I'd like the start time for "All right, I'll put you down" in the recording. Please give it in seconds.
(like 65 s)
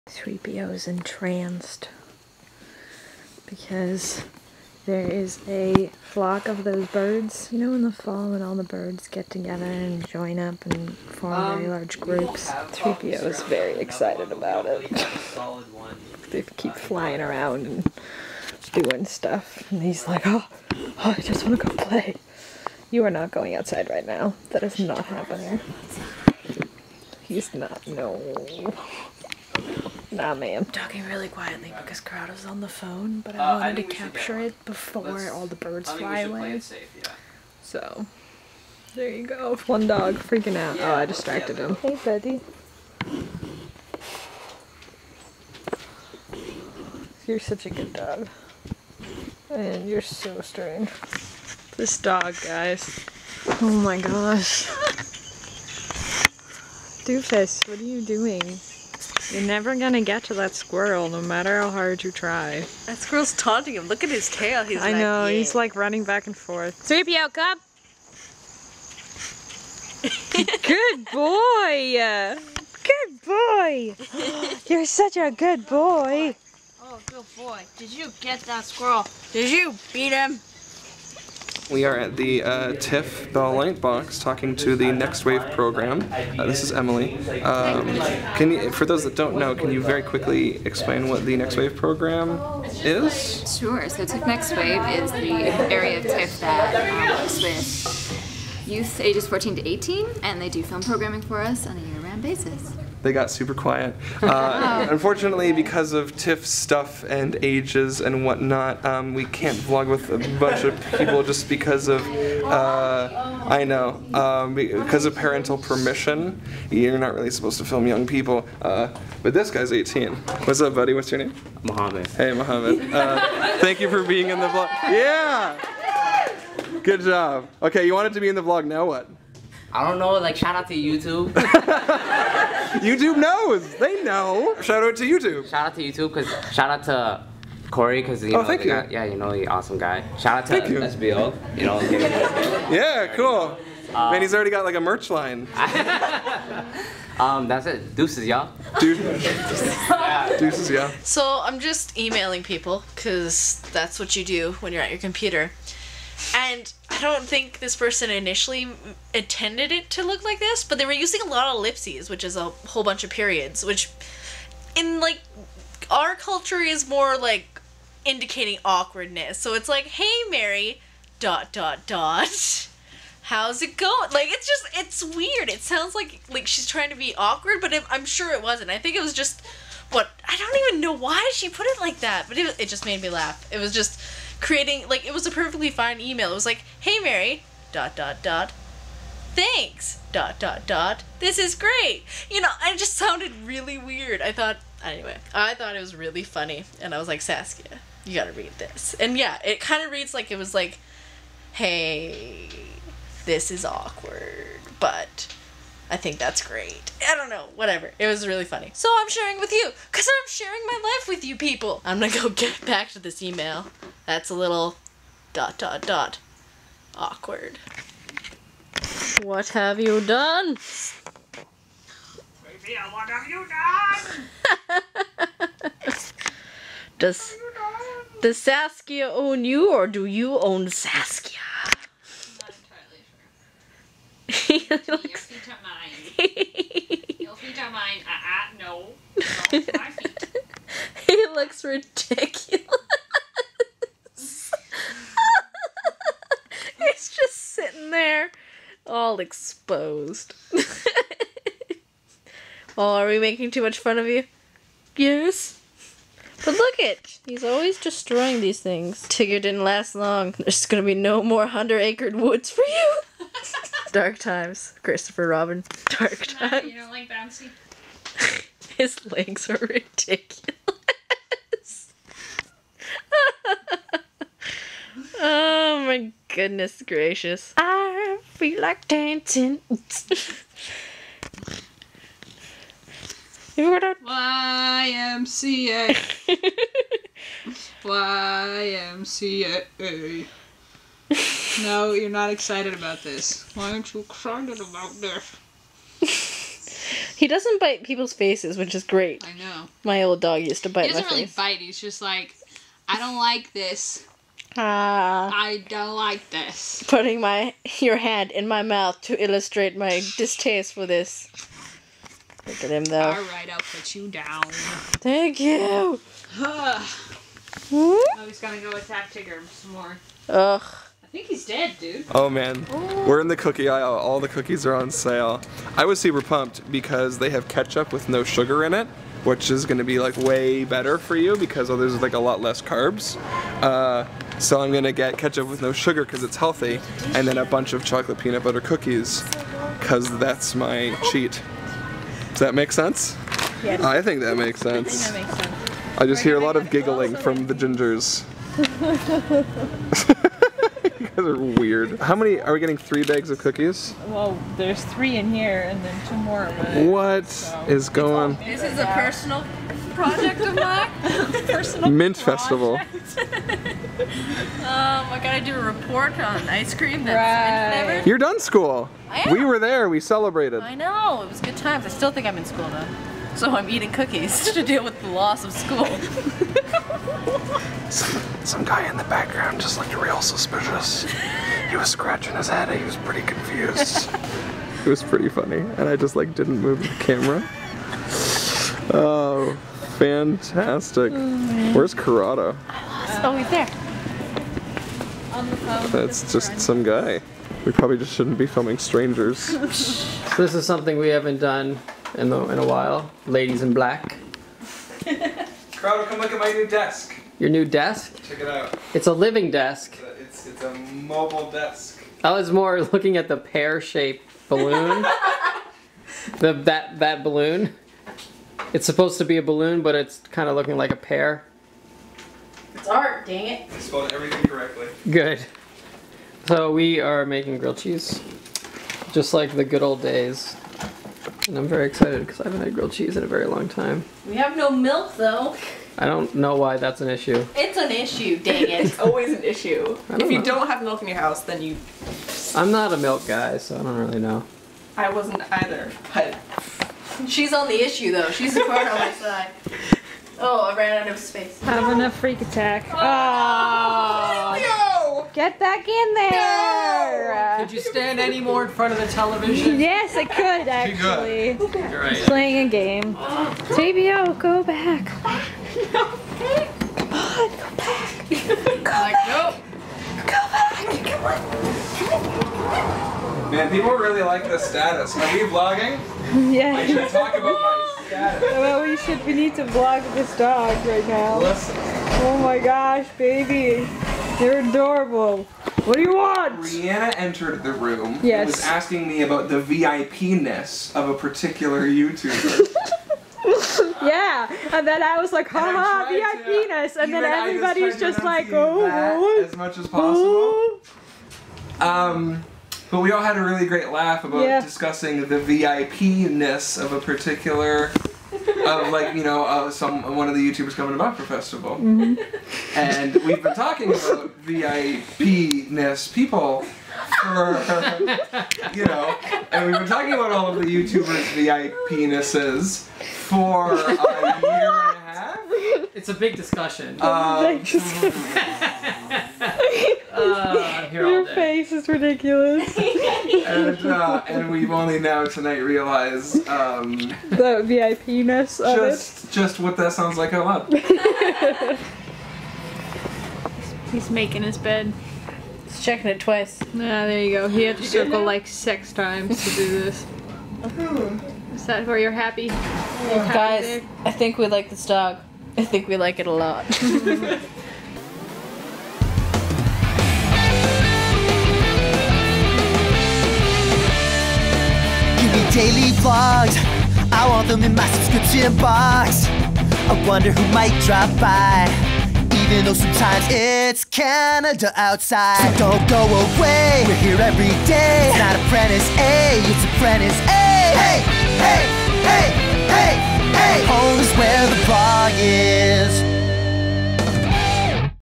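313 s.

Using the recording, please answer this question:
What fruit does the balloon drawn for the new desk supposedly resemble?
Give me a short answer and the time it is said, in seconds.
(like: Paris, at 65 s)
pear, at 420 s.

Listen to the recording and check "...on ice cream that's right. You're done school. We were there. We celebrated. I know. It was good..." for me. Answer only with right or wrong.
right.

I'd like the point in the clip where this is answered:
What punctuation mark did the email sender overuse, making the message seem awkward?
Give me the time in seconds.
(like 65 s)
161 s.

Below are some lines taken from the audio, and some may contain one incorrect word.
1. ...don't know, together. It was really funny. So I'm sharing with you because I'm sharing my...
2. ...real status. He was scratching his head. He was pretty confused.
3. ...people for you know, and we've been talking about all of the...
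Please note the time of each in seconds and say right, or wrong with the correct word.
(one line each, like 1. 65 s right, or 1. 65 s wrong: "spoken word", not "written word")
1. 207 s wrong: "whatever", not "together"
2. 379 s wrong: "suspicious", not "status"
3. 516 s right.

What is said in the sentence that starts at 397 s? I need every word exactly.
We probably just shouldn't be filming strangers.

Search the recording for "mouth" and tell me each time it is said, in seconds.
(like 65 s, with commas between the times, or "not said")
308 s.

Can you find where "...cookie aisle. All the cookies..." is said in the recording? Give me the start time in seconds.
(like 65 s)
323 s.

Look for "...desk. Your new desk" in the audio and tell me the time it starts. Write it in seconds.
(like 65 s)
406 s.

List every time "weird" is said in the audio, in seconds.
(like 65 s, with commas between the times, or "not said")
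175 s, 193 s, 351 s.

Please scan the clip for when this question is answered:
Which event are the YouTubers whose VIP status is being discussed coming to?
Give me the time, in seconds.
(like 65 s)
510 s.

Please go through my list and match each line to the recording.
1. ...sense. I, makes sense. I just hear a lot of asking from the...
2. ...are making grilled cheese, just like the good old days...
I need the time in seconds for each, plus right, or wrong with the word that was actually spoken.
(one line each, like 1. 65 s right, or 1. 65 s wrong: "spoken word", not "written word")
1. 344 s wrong: "giggling", not "asking"
2. 426 s right.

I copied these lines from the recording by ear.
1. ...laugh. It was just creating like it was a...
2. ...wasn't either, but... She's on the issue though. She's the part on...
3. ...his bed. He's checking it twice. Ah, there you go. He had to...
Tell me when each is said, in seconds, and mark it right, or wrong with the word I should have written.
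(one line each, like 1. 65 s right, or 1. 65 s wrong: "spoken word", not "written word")
1. 183 s right
2. 445 s right
3. 544 s right.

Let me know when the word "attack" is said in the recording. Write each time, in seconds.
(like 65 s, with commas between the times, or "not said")
318 s, 452 s.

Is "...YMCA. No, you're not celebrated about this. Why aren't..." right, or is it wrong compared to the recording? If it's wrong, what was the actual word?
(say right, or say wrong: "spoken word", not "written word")
wrong: "excited", not "celebrated".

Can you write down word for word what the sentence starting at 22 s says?
You are not going outside right now.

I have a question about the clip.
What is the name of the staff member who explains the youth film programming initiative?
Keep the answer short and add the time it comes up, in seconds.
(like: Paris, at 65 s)
Emily, at 86 s.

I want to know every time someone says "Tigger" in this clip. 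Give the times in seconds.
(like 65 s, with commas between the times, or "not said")
259 s, 319 s.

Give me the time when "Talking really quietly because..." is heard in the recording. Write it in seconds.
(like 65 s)
30 s.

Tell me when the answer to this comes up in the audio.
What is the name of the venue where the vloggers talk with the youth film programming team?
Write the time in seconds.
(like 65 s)
82 s.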